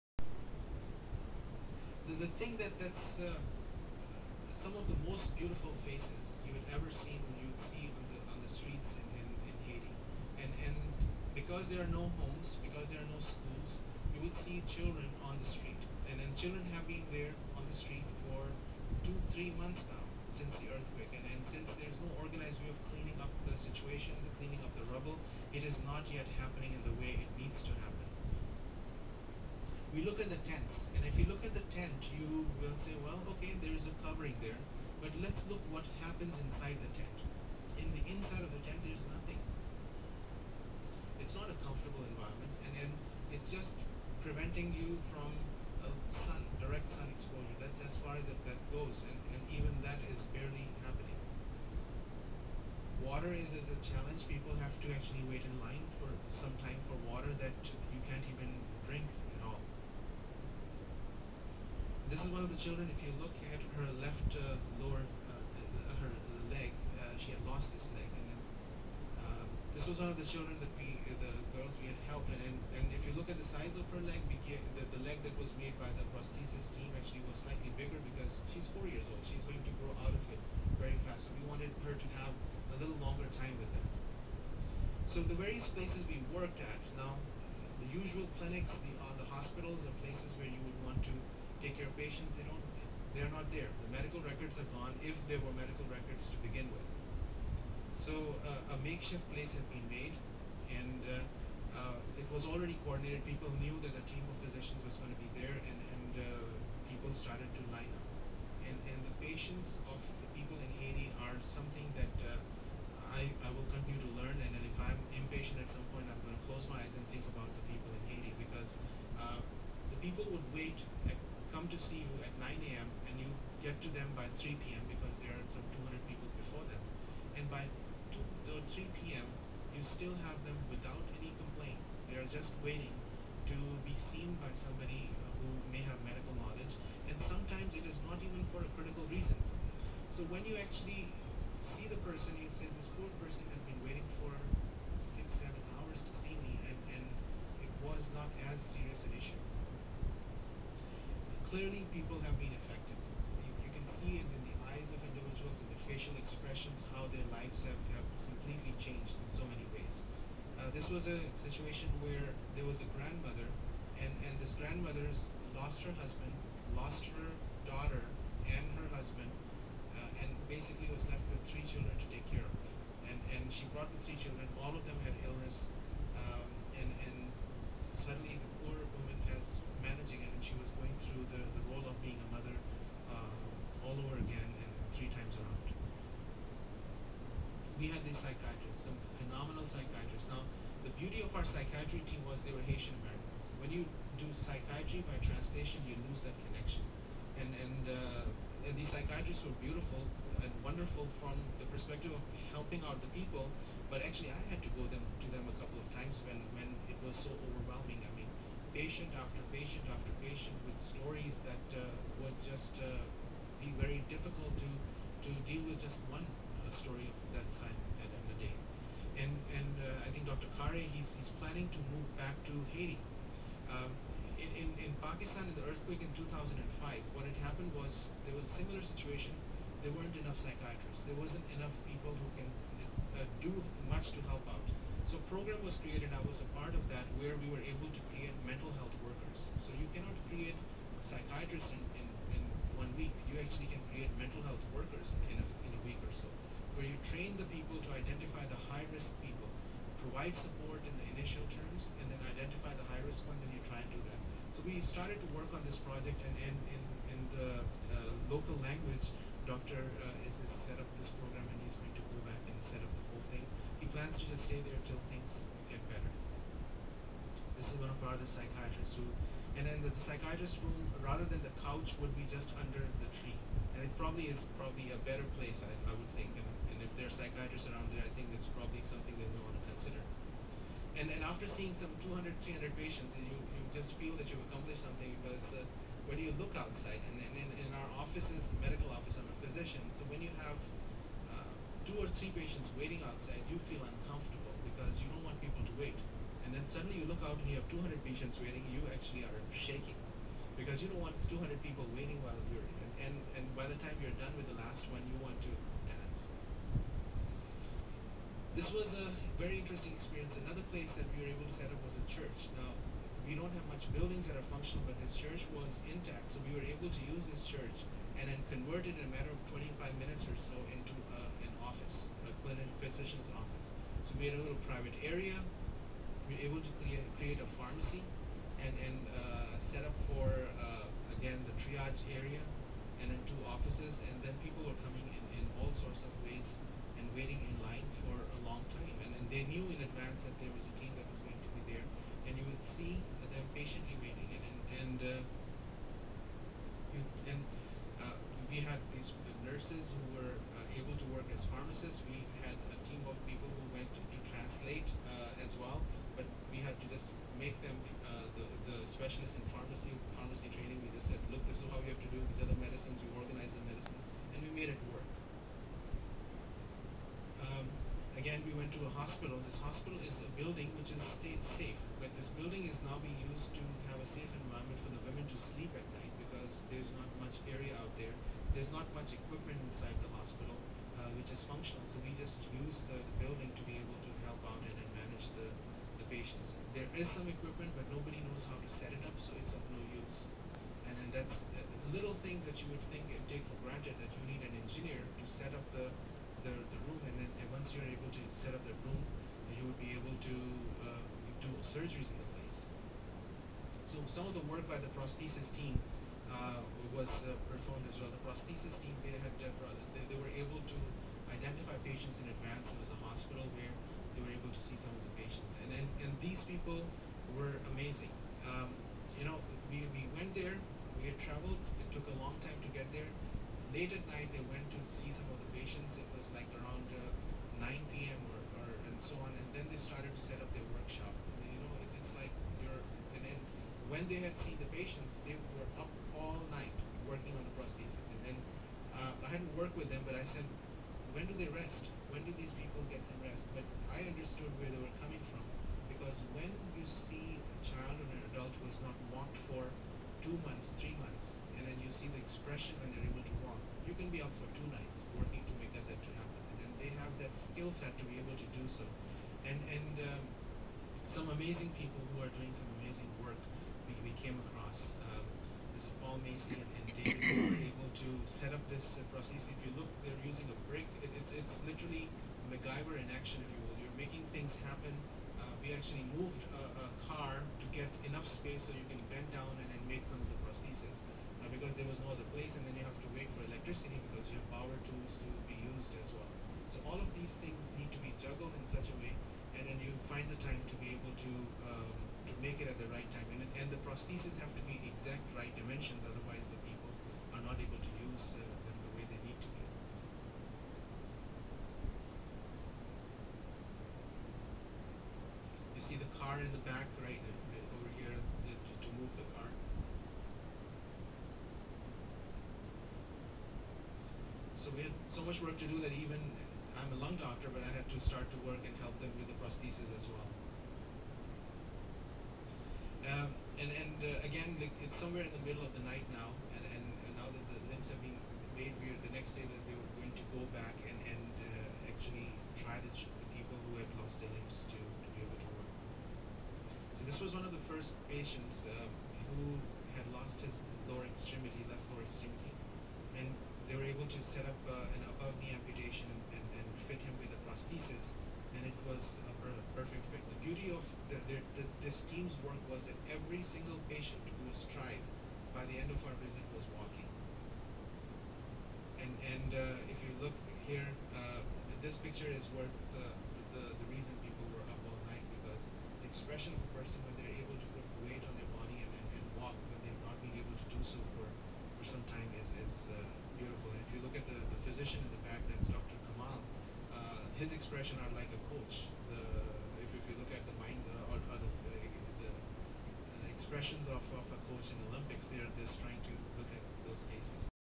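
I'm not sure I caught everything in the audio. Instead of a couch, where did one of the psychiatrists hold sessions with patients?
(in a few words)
Under the tree.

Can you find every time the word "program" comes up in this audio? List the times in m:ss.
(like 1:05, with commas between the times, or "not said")
3:55, 4:21.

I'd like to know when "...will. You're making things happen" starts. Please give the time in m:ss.
7:53.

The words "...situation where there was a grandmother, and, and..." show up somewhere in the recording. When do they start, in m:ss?
2:41.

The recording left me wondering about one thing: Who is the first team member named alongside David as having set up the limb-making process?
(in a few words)
Paul Macy.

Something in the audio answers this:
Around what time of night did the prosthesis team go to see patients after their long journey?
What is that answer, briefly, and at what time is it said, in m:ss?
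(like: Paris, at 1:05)
9 p.m., at 7:07.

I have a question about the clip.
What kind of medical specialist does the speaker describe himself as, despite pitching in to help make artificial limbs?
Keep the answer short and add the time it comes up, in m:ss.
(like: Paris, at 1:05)
Lung doctor, at 8:37.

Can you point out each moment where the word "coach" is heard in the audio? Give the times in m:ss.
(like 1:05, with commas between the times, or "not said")
9:38, 9:44.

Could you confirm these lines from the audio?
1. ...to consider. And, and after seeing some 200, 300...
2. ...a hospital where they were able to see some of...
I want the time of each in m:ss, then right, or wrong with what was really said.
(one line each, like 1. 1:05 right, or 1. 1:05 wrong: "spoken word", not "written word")
1. 4:39 right
2. 6:52 right.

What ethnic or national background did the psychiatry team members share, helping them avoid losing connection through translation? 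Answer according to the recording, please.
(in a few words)
Haitian Americans.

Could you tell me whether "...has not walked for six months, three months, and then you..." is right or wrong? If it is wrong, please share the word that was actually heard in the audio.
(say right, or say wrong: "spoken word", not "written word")
wrong: "two", not "six".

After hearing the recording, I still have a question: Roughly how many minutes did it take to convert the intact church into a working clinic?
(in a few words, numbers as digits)
25.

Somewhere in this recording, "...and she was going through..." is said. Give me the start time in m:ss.
3:00.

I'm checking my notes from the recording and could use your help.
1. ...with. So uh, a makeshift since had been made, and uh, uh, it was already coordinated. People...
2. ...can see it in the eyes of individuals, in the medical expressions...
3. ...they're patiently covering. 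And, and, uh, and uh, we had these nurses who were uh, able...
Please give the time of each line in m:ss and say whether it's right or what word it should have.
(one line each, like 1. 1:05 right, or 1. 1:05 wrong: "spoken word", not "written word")
1. 1:36 wrong: "place", not "since"
2. 2:33 wrong: "facial", not "medical"
3. 5:43 wrong: "waiting", not "covering".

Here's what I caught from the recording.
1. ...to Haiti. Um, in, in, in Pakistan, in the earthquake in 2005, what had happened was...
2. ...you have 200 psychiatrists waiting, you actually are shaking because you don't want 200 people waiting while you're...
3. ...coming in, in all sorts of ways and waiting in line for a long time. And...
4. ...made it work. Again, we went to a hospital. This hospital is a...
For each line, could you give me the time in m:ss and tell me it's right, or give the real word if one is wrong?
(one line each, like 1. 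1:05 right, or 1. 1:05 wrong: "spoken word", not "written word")
1. 3:42 right
2. 4:57 wrong: "patients", not "psychiatrists"
3. 5:34 right
4. 6:04 right.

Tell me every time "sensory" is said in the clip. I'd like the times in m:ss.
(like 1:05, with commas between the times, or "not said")
not said.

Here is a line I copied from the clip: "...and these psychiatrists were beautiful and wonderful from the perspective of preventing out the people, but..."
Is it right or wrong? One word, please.
wrong.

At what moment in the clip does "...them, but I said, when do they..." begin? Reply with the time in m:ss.
7:19.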